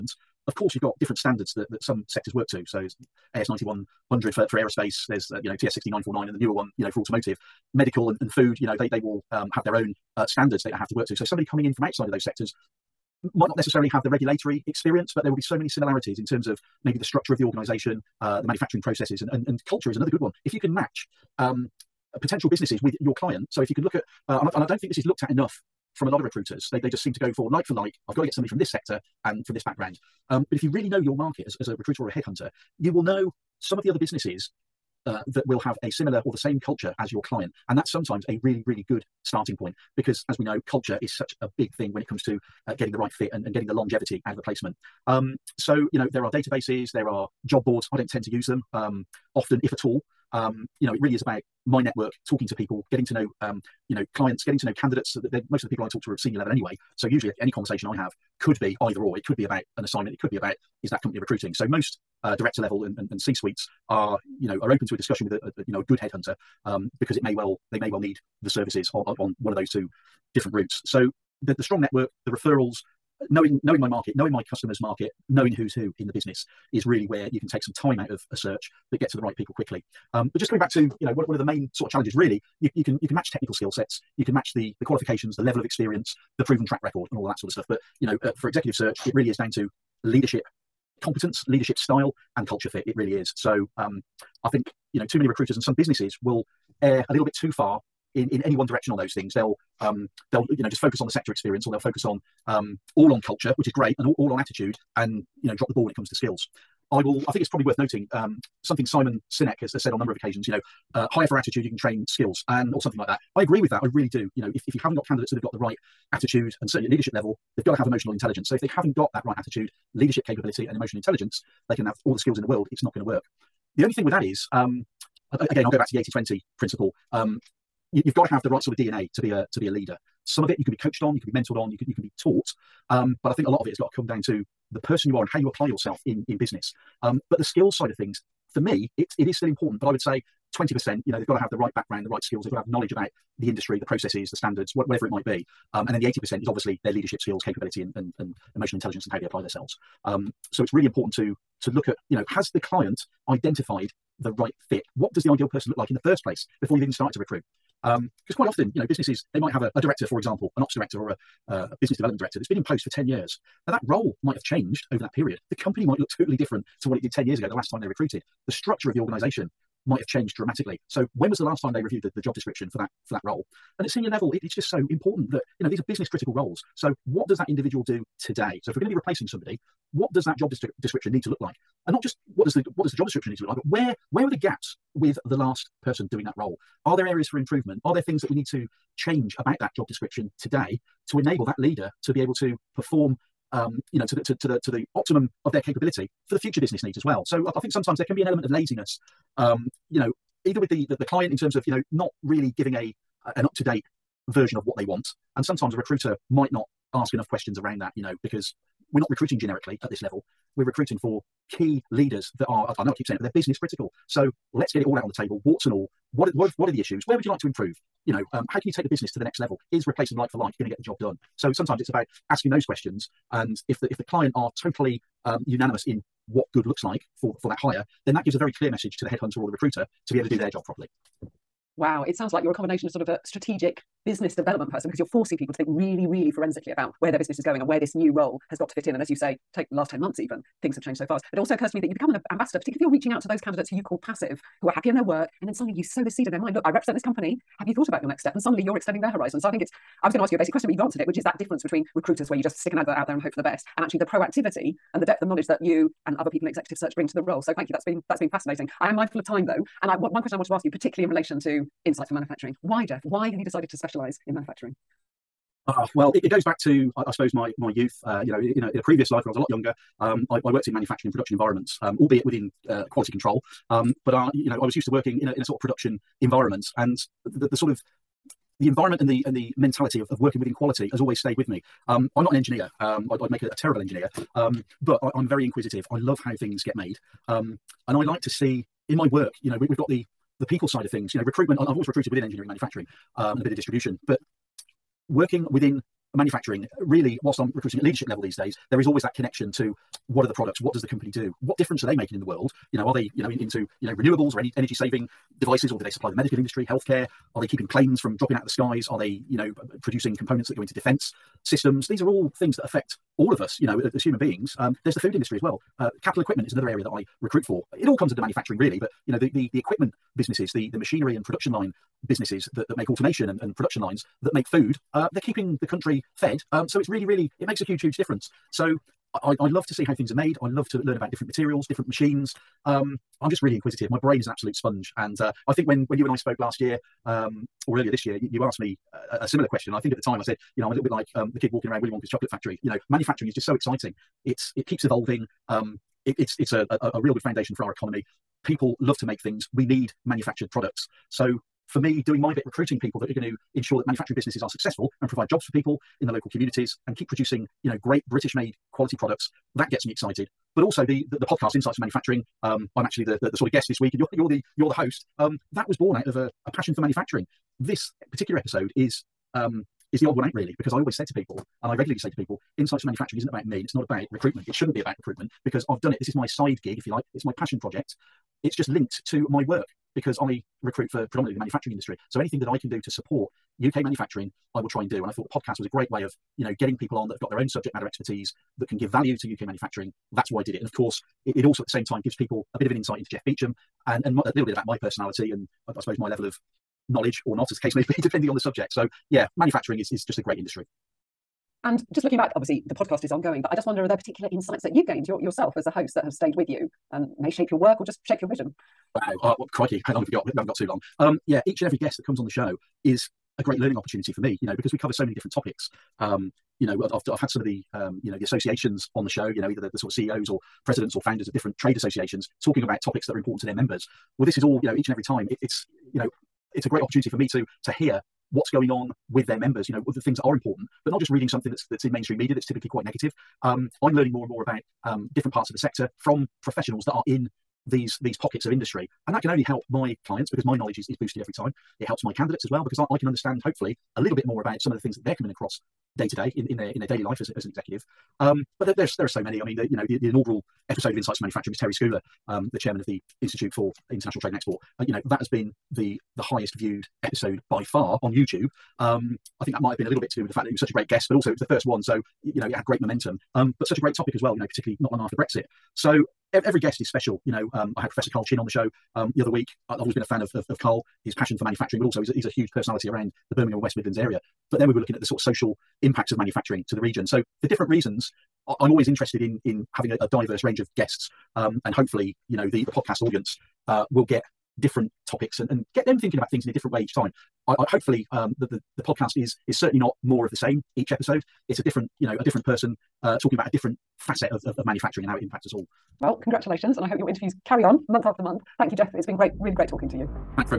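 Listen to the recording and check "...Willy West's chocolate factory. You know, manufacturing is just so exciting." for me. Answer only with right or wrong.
wrong.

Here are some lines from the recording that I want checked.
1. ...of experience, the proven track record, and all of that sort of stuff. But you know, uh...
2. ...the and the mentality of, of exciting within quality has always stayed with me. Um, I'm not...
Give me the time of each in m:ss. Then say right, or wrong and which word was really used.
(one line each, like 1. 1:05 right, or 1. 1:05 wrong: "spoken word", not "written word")
1. 1:25 right
2. 4:39 wrong: "working", not "exciting".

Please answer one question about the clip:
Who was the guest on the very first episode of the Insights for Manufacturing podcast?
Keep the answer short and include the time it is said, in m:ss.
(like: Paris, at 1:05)
Terry Scuoler, at 7:31.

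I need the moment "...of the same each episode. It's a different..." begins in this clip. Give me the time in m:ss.
8:10.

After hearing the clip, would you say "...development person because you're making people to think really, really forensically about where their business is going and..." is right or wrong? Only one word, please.
wrong.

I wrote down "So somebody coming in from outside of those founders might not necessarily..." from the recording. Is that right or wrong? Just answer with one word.
wrong.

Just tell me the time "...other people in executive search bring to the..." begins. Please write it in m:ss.
4:16.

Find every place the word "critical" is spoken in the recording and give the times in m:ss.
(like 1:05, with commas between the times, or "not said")
2:56, 3:33.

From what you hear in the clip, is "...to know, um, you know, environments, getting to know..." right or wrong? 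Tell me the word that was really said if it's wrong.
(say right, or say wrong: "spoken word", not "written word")
wrong: "clients", not "environments".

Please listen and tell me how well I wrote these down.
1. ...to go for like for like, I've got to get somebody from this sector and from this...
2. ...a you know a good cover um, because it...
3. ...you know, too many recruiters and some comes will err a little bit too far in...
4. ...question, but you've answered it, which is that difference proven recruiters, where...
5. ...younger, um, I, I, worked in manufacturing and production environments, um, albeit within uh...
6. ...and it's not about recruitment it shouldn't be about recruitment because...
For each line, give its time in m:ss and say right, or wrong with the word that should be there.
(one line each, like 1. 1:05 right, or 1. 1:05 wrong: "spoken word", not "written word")
1. 0:27 right
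2. 1:05 wrong: "headhunter", not "cover"
3. 1:34 wrong: "businesses", not "comes"
4. 4:10 wrong: "between", not "proven"
5. 4:29 right
6. 6:13 right.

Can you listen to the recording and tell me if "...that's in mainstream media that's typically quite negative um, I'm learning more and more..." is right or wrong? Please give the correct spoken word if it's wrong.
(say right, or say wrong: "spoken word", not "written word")
right.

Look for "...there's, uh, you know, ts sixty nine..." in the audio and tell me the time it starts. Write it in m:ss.
0:05.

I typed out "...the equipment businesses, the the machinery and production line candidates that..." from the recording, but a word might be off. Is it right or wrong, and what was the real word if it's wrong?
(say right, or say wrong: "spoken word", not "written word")
wrong: "businesses", not "candidates".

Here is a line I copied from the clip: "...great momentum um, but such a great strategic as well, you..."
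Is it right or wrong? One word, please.
wrong.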